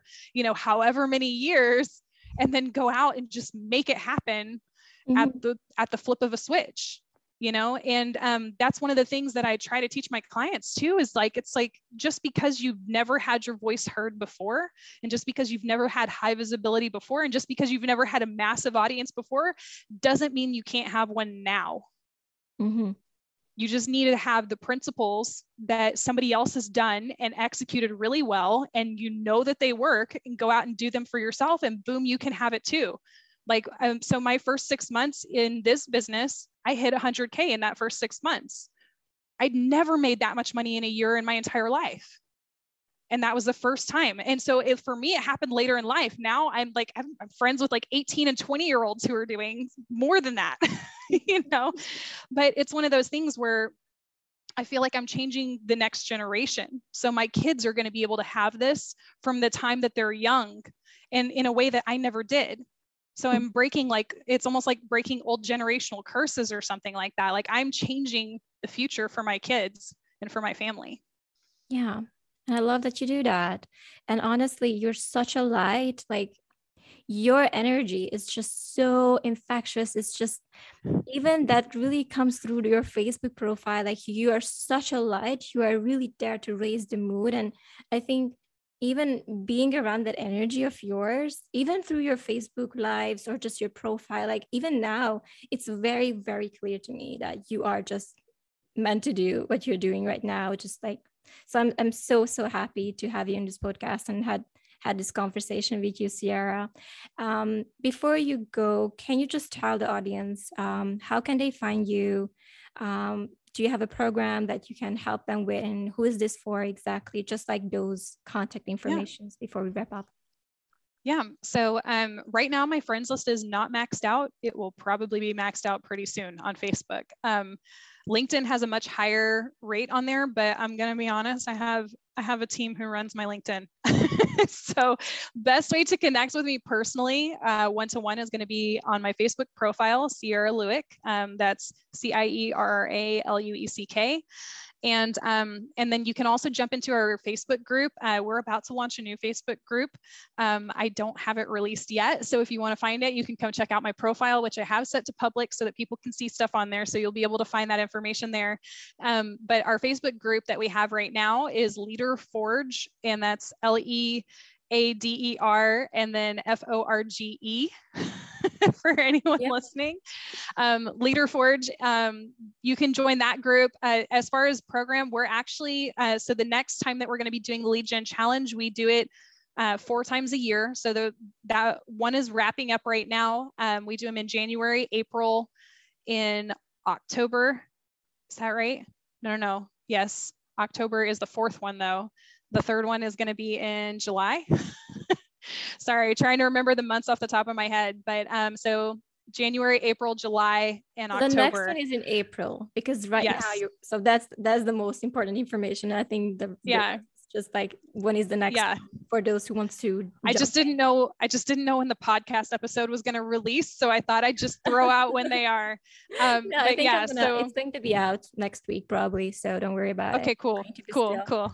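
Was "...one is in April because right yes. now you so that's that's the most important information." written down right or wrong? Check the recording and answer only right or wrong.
right.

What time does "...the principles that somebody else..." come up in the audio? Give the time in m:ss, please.
0:24.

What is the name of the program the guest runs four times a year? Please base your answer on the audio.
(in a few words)
Lead Gen Challenge.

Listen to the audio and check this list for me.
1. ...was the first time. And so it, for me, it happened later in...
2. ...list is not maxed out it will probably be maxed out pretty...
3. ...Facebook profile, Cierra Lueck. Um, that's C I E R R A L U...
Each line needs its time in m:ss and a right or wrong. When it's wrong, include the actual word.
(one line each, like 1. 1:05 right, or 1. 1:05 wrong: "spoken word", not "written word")
1. 0:43 right
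2. 2:03 right
3. 2:19 right.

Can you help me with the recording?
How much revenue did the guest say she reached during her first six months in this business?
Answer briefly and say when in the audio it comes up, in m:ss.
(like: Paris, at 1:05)
100K, at 0:36.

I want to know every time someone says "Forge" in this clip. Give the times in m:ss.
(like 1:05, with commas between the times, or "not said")
2:42, 2:51.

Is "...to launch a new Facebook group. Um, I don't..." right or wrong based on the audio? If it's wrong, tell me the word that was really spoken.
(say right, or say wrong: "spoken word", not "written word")
right.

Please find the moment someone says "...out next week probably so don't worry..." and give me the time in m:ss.
3:37.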